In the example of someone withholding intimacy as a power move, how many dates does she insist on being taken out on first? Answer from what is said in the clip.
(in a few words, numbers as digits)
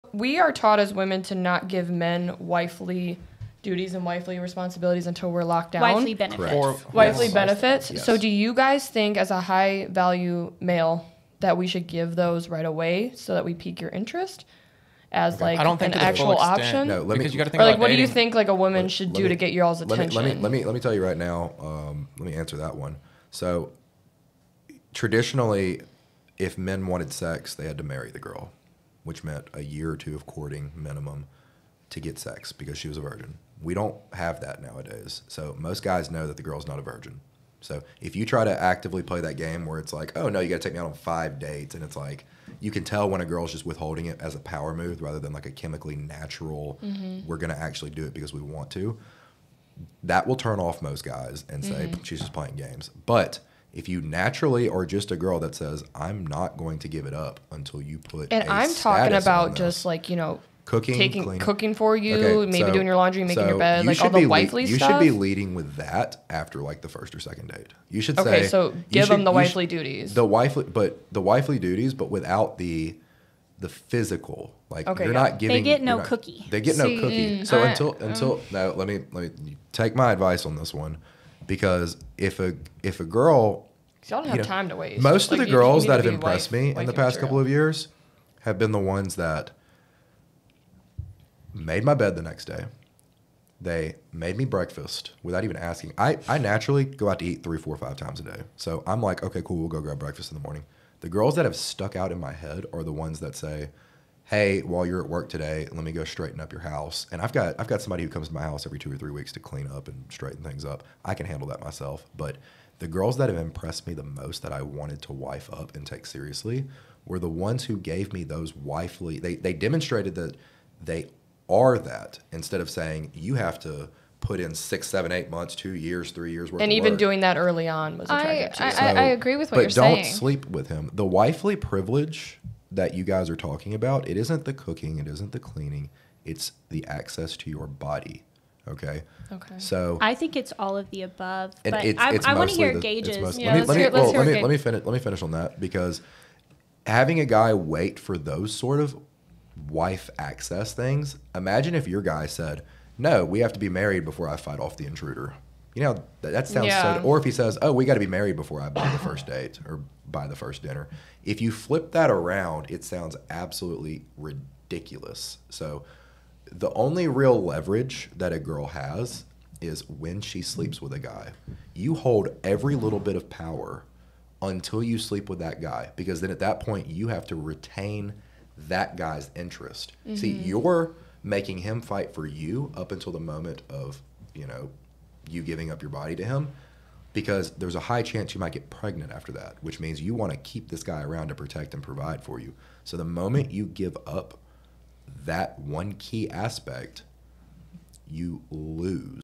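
5 dates.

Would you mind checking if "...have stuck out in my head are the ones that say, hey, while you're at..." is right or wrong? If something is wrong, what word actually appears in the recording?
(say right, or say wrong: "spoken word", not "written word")
right.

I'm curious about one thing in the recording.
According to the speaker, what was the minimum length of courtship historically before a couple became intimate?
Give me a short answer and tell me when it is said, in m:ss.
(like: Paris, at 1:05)
a year or two, at 0:29.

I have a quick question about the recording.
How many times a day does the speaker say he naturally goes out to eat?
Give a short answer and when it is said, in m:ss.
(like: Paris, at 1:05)
3, 4, 5 times a day, at 1:37.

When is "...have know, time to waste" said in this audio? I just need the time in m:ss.
1:24.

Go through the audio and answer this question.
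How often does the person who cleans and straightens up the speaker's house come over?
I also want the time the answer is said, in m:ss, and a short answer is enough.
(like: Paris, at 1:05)
every 2 or 3 weeks, at 1:48.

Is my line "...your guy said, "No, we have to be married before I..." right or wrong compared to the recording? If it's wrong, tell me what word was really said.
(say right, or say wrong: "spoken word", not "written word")
right.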